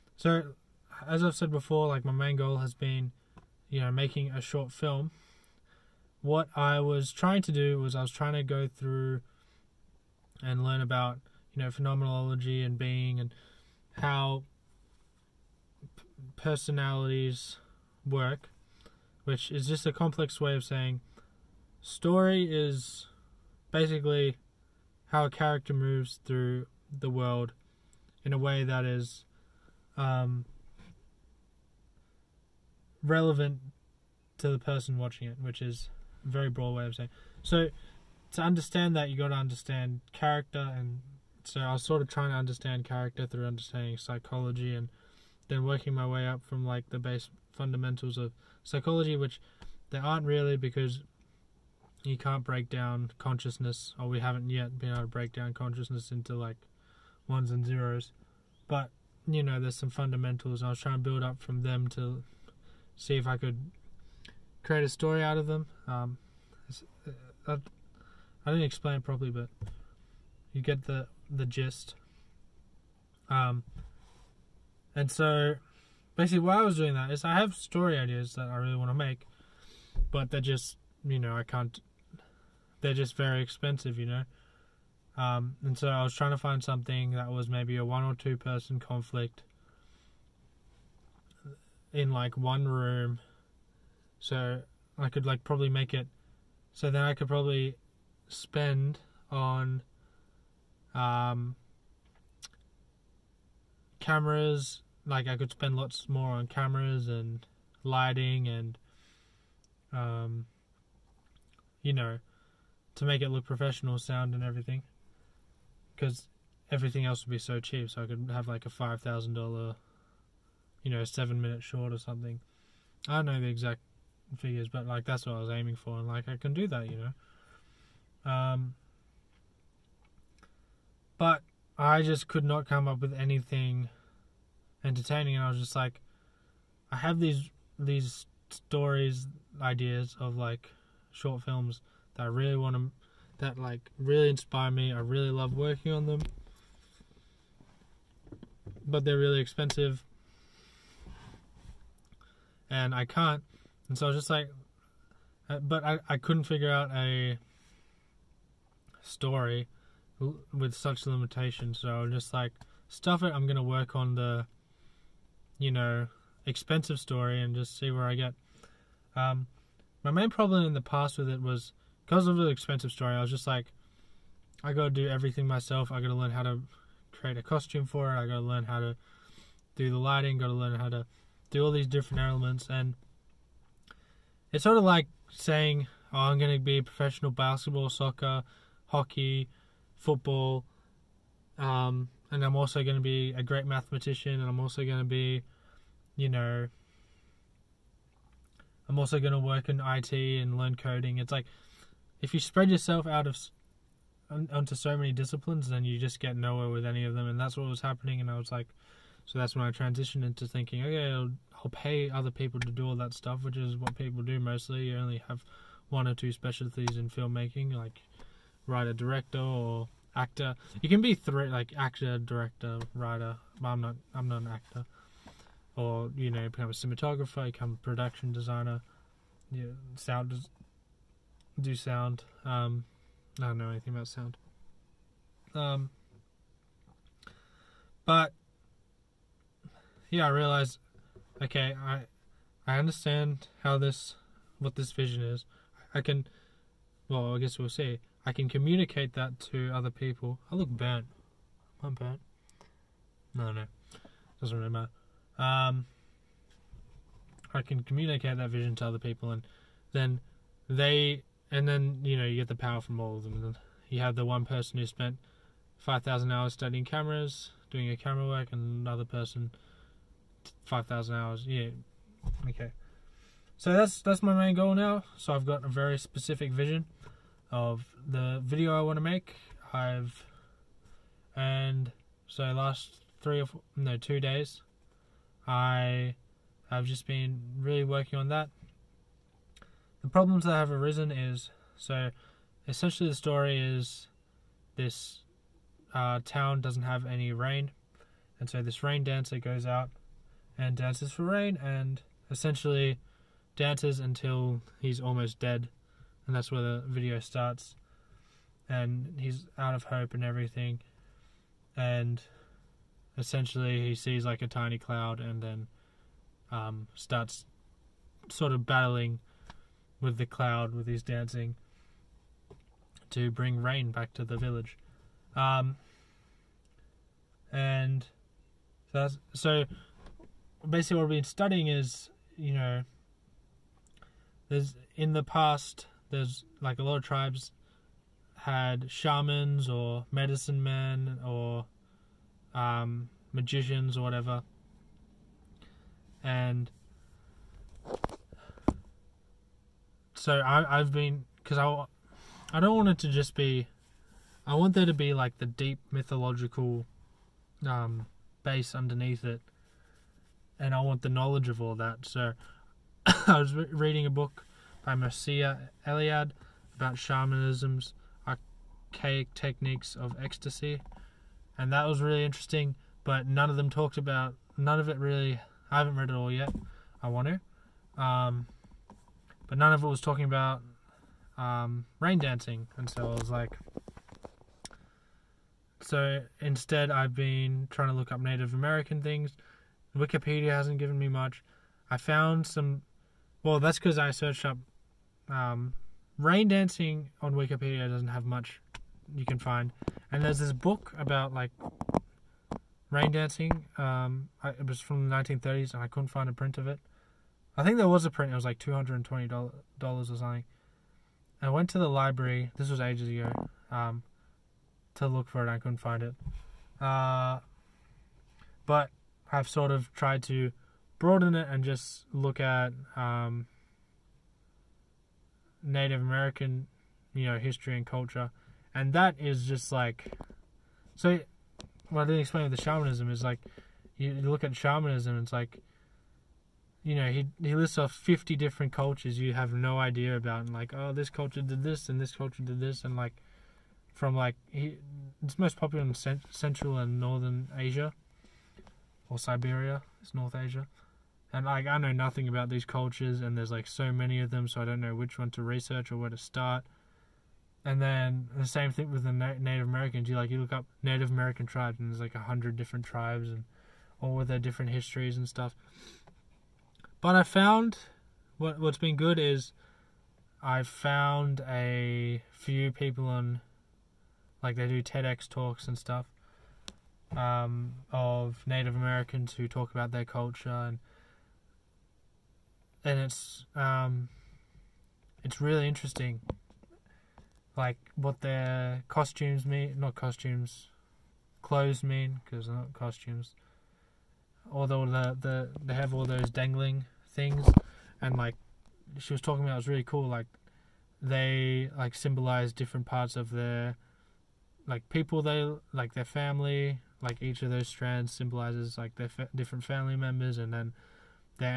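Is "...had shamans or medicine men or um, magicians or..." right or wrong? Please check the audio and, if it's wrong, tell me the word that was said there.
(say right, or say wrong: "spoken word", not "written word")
right.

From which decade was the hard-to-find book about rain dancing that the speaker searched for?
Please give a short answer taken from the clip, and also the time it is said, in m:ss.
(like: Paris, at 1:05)
1930s, at 6:45.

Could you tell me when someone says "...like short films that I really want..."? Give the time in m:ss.
2:20.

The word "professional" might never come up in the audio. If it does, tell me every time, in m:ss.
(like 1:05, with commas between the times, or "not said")
1:53, 3:06.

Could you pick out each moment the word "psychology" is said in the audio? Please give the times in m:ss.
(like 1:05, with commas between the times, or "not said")
0:43, 0:48.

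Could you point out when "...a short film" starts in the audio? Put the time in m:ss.
0:04.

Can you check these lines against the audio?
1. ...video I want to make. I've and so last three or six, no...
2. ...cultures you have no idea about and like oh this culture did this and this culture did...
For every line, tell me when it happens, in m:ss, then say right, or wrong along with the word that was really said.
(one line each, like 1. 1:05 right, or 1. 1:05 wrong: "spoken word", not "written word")
1. 4:38 wrong: "four", not "six"
2. 7:18 right.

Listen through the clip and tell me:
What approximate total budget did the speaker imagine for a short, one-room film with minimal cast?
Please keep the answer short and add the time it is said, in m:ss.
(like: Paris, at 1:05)
$5,000, at 1:58.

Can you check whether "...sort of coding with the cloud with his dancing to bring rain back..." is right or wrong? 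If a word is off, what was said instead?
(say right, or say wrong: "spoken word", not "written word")
wrong: "battling", not "coding".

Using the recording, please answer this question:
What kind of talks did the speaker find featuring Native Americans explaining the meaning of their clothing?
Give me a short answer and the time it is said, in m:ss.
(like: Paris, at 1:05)
TEDx talks, at 7:54.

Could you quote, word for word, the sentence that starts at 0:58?
But you know, there's some fundamentals.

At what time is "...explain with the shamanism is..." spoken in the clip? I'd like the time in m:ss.
7:12.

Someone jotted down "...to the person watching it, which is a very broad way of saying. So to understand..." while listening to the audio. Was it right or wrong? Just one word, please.
right.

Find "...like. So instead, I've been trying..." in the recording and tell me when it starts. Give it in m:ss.
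6:23.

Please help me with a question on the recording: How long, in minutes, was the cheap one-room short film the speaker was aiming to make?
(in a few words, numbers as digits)
7 minutes.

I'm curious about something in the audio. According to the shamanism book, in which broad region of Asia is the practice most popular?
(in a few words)
Central and northern Asia.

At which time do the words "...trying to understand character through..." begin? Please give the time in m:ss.
0:42.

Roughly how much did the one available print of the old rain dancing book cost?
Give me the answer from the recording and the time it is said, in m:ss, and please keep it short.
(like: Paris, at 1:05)
$220, at 6:48.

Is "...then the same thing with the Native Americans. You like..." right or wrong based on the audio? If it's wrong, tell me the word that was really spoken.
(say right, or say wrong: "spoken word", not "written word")
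right.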